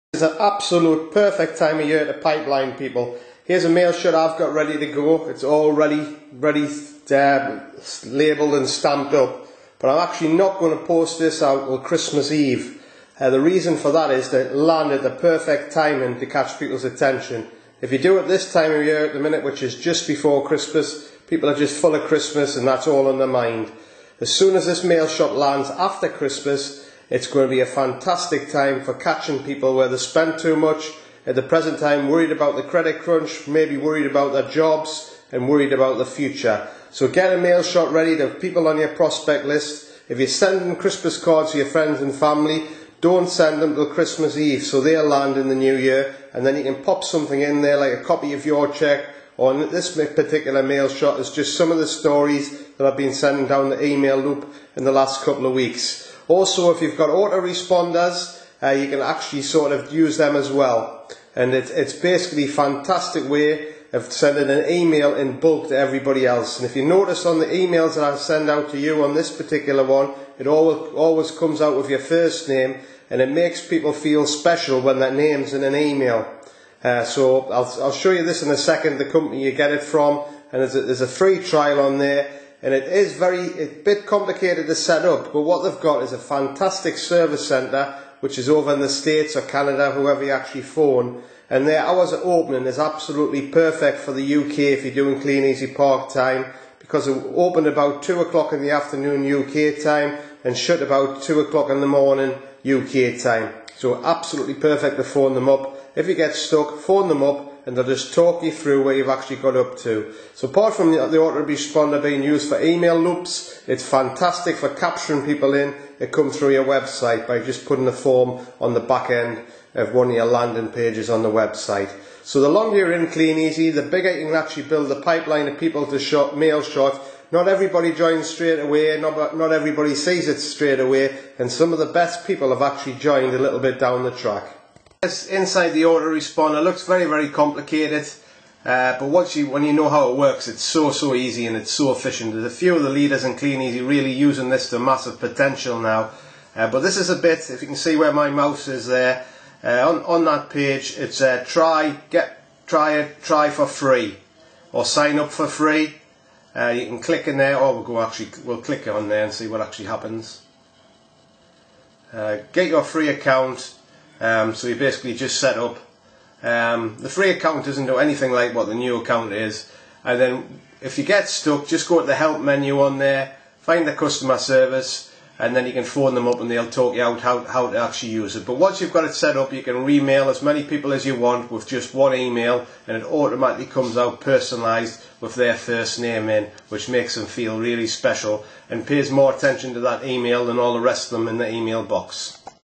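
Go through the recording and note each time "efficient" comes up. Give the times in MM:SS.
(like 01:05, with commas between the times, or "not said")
02:21.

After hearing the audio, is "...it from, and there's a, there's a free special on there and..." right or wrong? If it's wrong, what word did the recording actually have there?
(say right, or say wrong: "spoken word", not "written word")
wrong: "trial", not "special".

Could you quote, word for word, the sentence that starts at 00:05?
It's all ready, ready, uh, labelled and stamped up.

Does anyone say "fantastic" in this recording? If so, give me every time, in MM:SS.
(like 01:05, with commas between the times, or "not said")
00:27, 01:02, 01:26, 01:53.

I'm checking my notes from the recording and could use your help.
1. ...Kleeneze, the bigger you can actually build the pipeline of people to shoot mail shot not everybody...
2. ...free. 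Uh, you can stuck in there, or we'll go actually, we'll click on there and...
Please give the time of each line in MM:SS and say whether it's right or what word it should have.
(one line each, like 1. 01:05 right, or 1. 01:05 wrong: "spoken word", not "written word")
1. 02:03 right
2. 02:35 wrong: "click", not "stuck".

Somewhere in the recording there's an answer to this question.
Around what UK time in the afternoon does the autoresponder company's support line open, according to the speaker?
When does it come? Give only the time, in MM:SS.
01:38.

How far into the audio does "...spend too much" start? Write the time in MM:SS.
00:29.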